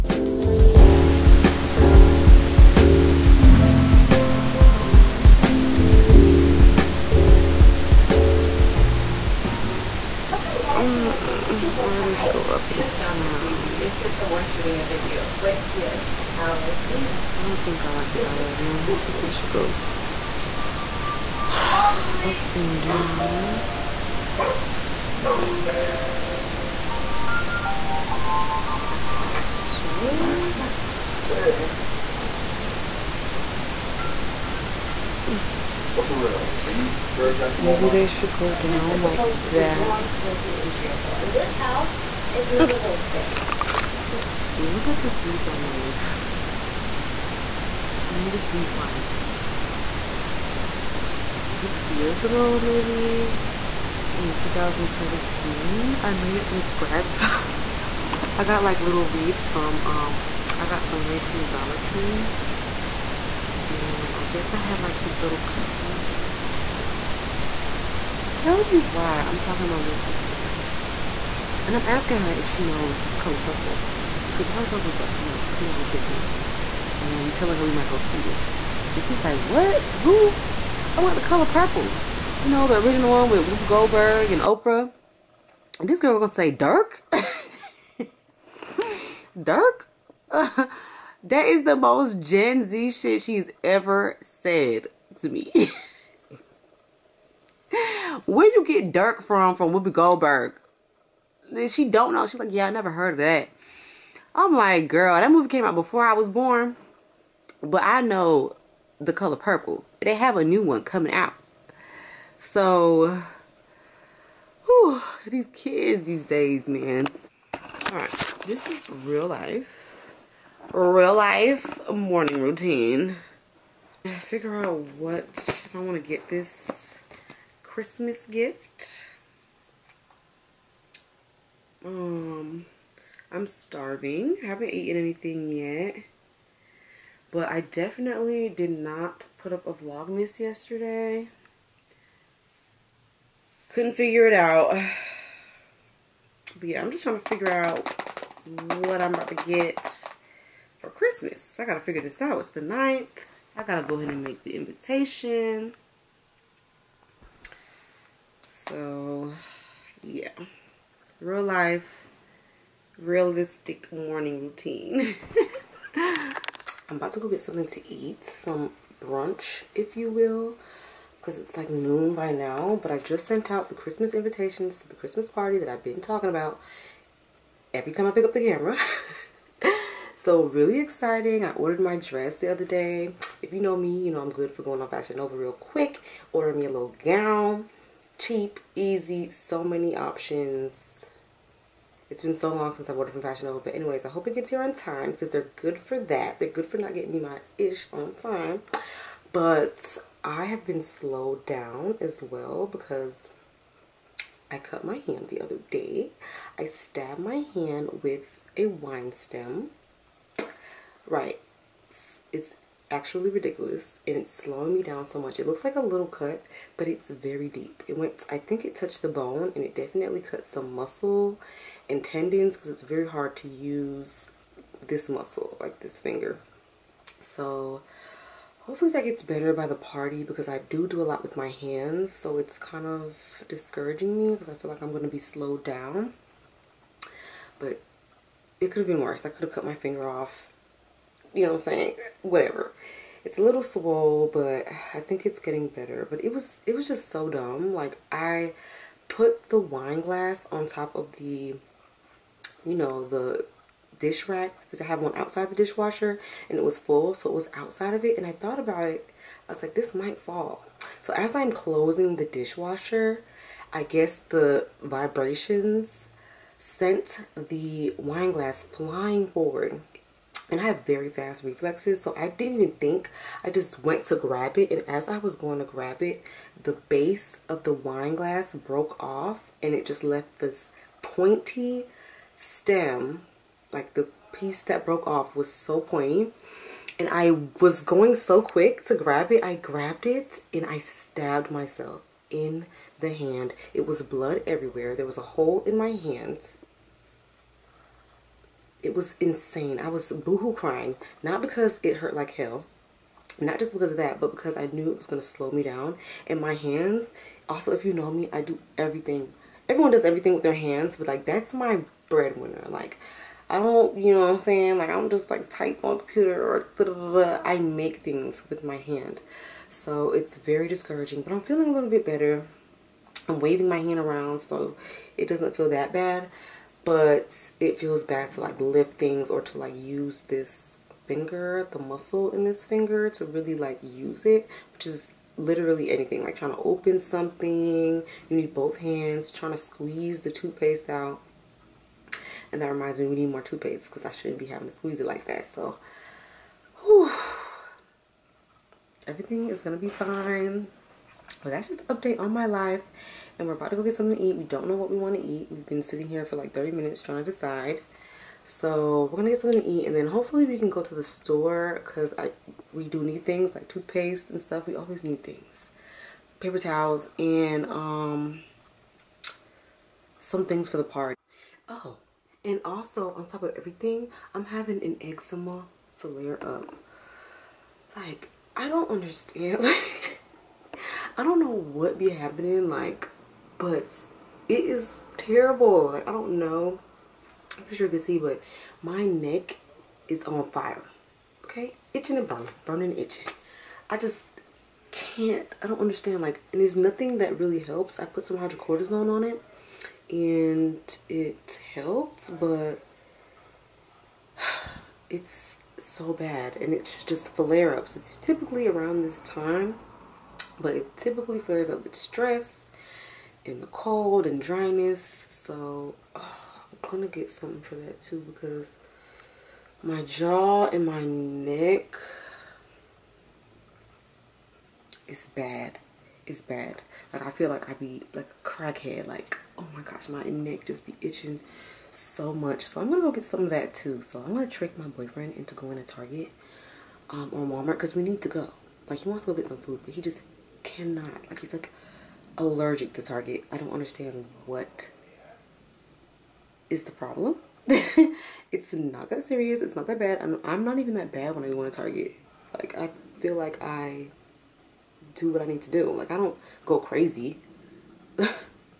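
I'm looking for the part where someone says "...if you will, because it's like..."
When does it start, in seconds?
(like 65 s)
169 s.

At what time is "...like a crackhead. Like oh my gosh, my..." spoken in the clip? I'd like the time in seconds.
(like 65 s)
428 s.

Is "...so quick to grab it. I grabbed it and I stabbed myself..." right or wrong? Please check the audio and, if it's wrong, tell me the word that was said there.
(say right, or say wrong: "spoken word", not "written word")
right.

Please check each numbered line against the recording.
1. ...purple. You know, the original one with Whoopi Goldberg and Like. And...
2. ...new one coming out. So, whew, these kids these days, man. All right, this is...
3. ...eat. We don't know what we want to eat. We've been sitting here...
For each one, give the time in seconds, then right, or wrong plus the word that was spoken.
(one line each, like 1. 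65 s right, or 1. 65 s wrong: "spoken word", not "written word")
1. 81 s wrong: "Oprah", not "Like"
2. 110 s right
3. 354 s right.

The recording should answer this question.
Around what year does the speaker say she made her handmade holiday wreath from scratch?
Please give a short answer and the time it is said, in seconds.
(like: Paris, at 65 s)
2017, at 54 s.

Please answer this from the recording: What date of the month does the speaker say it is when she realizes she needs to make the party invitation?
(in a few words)
9th.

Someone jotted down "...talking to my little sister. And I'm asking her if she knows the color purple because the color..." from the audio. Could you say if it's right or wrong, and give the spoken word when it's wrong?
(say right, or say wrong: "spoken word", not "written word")
right.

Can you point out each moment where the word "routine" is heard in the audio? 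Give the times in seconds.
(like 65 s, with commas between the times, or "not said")
122 s, 164 s.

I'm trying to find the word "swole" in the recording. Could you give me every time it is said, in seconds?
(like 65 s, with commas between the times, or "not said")
243 s.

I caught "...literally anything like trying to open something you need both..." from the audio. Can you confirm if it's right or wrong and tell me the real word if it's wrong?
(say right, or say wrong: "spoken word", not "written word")
right.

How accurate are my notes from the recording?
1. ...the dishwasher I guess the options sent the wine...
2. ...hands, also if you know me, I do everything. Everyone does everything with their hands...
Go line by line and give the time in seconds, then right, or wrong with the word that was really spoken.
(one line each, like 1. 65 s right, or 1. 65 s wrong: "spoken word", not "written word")
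1. 262 s wrong: "vibrations", not "options"
2. 306 s right.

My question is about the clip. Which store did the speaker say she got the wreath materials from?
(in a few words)
Dollar Tree.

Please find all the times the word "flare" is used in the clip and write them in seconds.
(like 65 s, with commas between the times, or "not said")
375 s, 407 s, 411 s.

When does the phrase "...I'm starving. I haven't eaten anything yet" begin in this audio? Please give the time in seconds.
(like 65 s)
133 s.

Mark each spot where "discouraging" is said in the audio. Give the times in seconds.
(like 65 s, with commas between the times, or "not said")
233 s, 320 s.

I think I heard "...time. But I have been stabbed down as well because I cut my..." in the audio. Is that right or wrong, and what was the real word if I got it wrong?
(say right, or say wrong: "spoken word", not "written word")
wrong: "slowed", not "stabbed".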